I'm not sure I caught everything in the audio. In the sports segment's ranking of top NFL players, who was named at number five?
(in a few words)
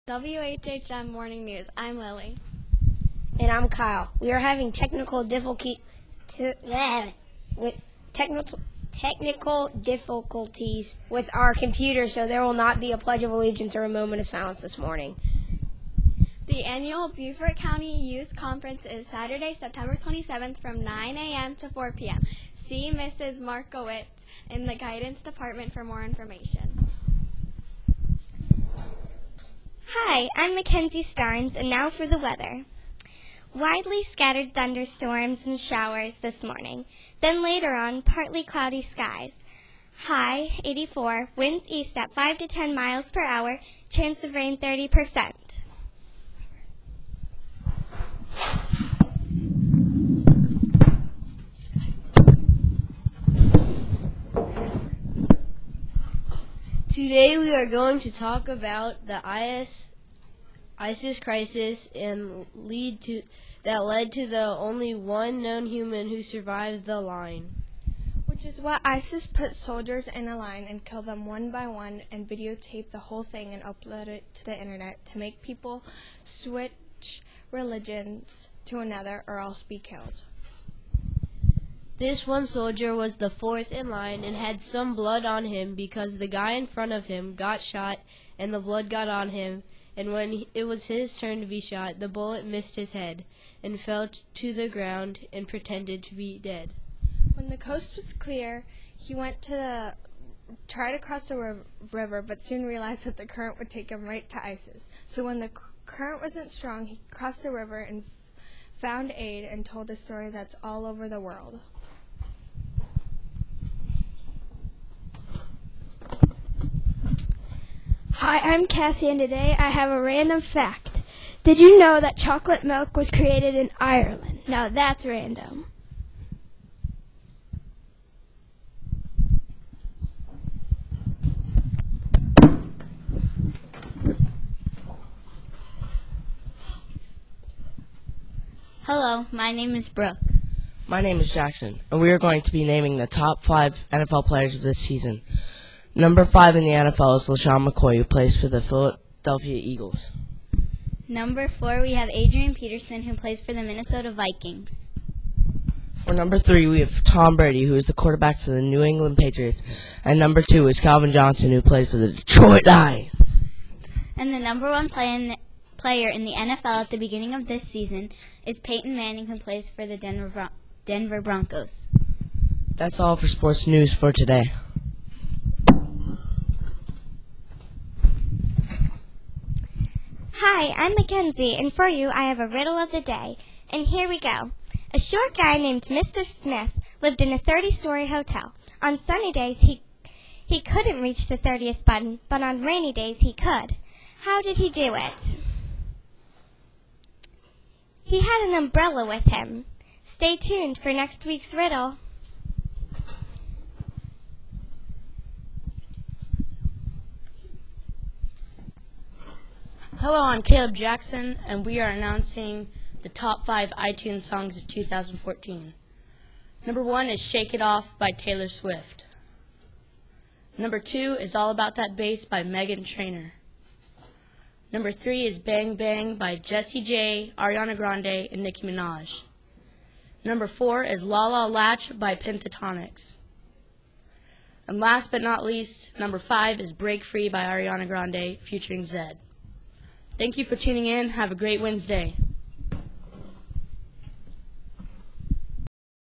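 LeSean McCoy.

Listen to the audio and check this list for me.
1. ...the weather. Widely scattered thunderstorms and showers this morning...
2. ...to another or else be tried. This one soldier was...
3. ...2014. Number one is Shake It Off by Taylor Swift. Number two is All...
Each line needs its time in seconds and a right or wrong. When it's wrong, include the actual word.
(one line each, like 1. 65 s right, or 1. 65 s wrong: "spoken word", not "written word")
1. 32 s right
2. 78 s wrong: "killed", not "tried"
3. 214 s right.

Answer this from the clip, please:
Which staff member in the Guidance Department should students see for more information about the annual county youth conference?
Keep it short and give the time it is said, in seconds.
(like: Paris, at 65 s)
Mrs. Markowitz, at 22 s.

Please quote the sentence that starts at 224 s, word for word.
Number three is Bang Bang by Jessie J, Ariana Grande, and Nicki Minaj.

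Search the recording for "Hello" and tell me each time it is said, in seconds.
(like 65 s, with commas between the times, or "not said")
138 s, 210 s.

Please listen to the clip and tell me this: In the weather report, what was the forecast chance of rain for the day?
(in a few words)
30%.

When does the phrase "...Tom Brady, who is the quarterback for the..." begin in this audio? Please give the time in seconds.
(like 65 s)
157 s.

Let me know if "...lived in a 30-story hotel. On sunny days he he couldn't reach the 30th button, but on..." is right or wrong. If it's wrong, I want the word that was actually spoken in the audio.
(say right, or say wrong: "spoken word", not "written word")
right.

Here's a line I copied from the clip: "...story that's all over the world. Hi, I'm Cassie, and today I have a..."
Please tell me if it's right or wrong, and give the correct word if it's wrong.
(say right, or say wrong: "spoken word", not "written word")
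right.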